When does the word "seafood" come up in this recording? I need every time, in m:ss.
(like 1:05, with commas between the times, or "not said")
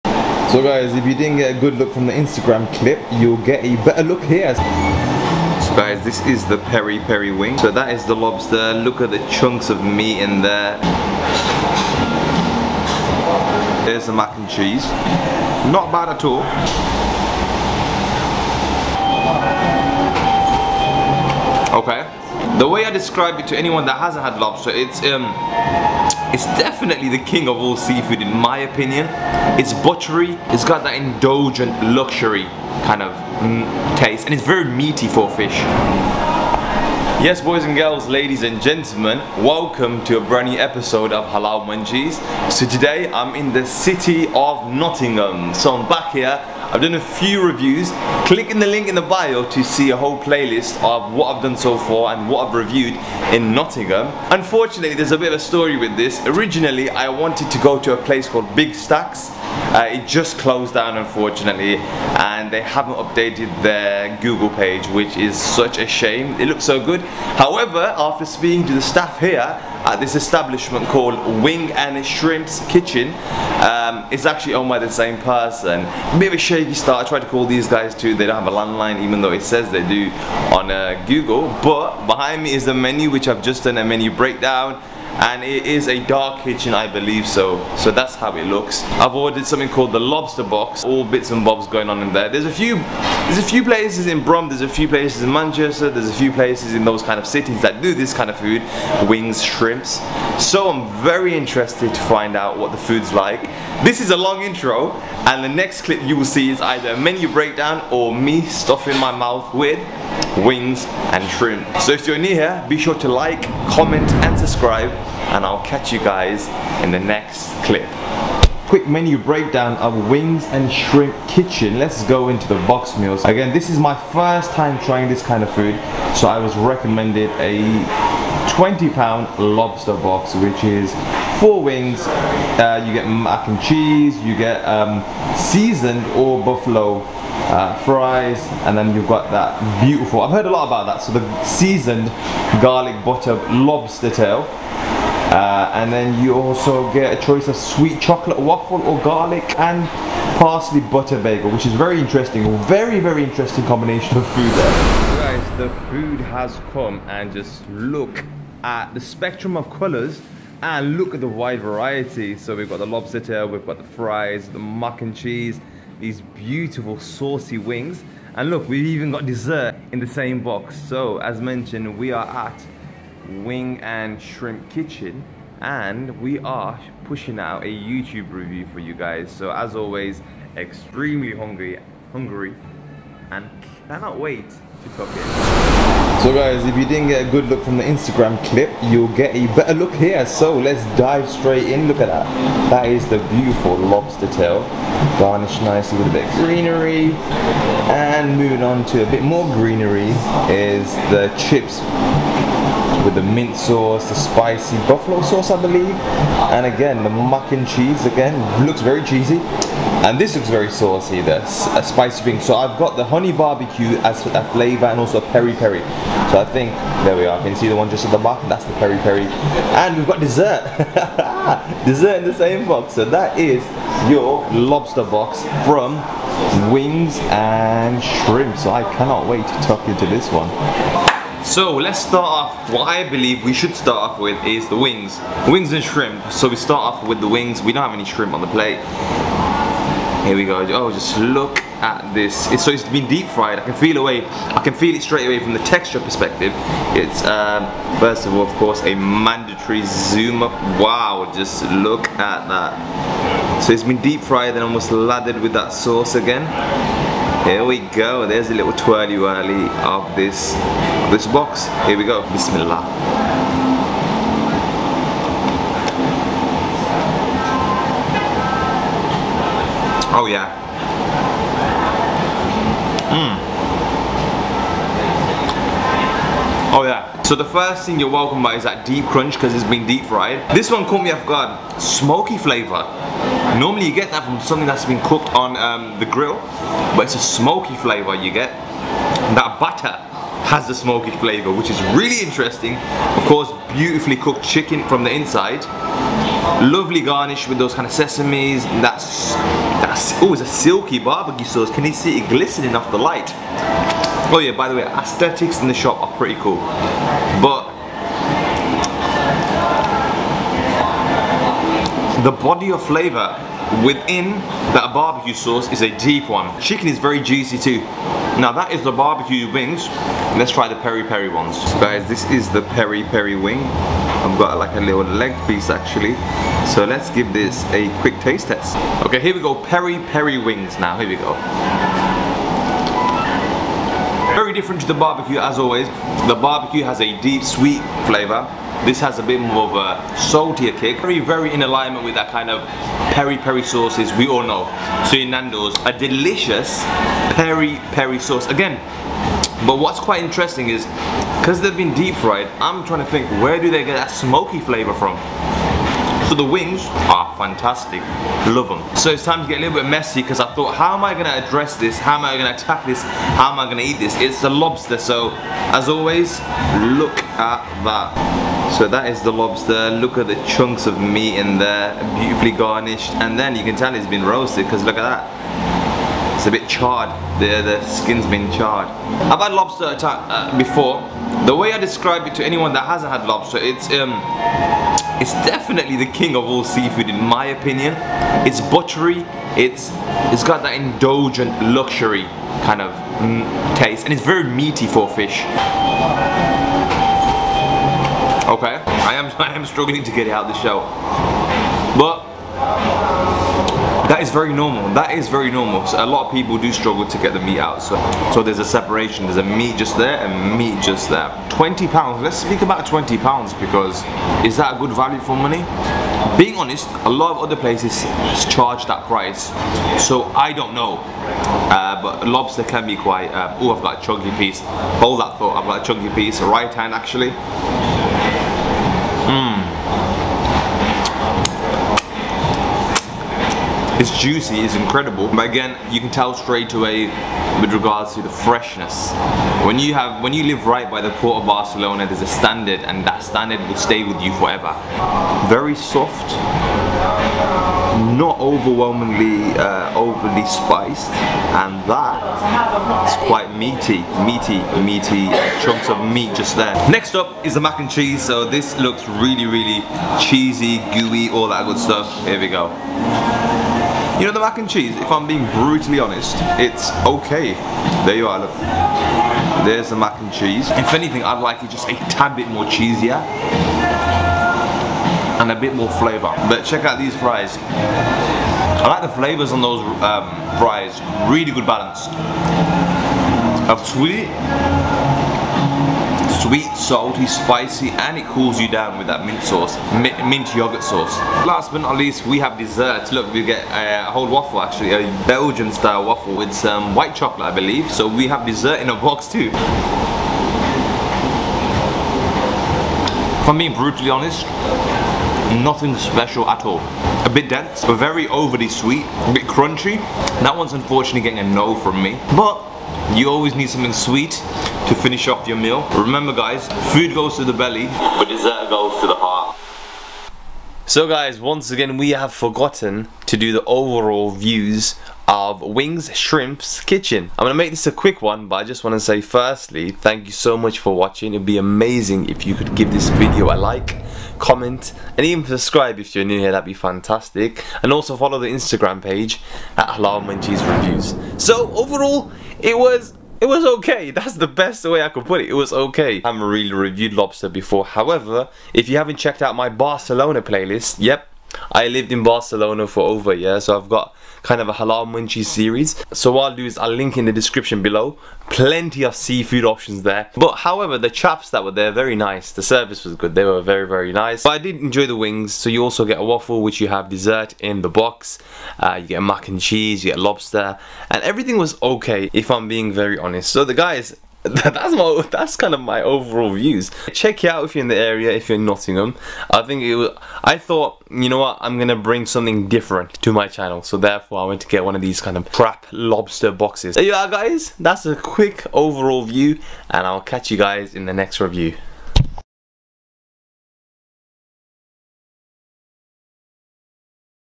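0:27, 6:26, 9:19.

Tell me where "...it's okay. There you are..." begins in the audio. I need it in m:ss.
7:46.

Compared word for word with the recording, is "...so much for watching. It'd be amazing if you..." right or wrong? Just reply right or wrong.
right.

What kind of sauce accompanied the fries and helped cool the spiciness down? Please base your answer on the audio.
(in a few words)
Mint yogurt sauce.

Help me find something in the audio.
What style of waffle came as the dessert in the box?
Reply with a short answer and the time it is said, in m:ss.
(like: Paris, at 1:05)
Belgian style, at 8:15.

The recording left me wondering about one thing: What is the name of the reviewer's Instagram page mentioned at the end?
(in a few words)
Halal Munchies Reviews.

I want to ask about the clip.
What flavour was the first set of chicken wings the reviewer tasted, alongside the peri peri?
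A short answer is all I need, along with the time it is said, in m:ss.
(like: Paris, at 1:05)
Honey barbecue, at 3:33.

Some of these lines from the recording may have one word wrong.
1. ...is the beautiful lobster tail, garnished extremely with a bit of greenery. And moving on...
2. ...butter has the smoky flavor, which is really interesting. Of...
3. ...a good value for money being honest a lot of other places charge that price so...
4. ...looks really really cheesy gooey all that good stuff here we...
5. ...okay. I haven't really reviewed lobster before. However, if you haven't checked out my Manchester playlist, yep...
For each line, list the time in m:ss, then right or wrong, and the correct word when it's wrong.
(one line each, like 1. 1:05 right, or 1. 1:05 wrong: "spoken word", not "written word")
1. 3:12 wrong: "nicely", not "extremely"
2. 4:49 right
3. 6:54 right
4. 7:38 right
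5. 9:05 wrong: "Barcelona", not "Manchester".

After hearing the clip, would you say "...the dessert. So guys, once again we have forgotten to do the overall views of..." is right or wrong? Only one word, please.
wrong.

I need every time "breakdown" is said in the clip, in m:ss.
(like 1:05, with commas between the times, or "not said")
1:24, 1:47, 1:59.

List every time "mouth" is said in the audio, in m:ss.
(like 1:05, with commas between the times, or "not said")
1:49.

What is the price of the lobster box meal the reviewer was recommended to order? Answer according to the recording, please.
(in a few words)
£20.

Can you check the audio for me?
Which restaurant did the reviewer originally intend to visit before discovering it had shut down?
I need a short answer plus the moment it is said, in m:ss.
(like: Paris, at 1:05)
Big Stacks, at 0:58.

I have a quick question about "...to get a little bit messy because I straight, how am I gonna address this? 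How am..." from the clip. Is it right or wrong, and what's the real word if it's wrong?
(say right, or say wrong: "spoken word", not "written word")
wrong: "thought", not "straight".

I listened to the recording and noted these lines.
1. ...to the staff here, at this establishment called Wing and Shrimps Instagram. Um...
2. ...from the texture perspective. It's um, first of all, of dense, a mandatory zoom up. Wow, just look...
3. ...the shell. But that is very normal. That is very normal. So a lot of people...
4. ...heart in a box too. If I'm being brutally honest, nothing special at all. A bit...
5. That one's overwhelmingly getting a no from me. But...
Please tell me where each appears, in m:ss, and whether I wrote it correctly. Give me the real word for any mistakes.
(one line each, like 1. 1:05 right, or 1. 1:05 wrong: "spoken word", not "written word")
1. 1:08 wrong: "Kitchen", not "Instagram"
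2. 4:05 wrong: "course", not "dense"
3. 6:40 right
4. 8:18 wrong: "dessert", not "heart"
5. 8:30 wrong: "unfortunately", not "overwhelmingly".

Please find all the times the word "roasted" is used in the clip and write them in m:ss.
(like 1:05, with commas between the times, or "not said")
6:14.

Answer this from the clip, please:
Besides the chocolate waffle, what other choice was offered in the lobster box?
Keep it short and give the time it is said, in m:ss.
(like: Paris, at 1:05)
Garlic and parsley butter bagel, at 2:29.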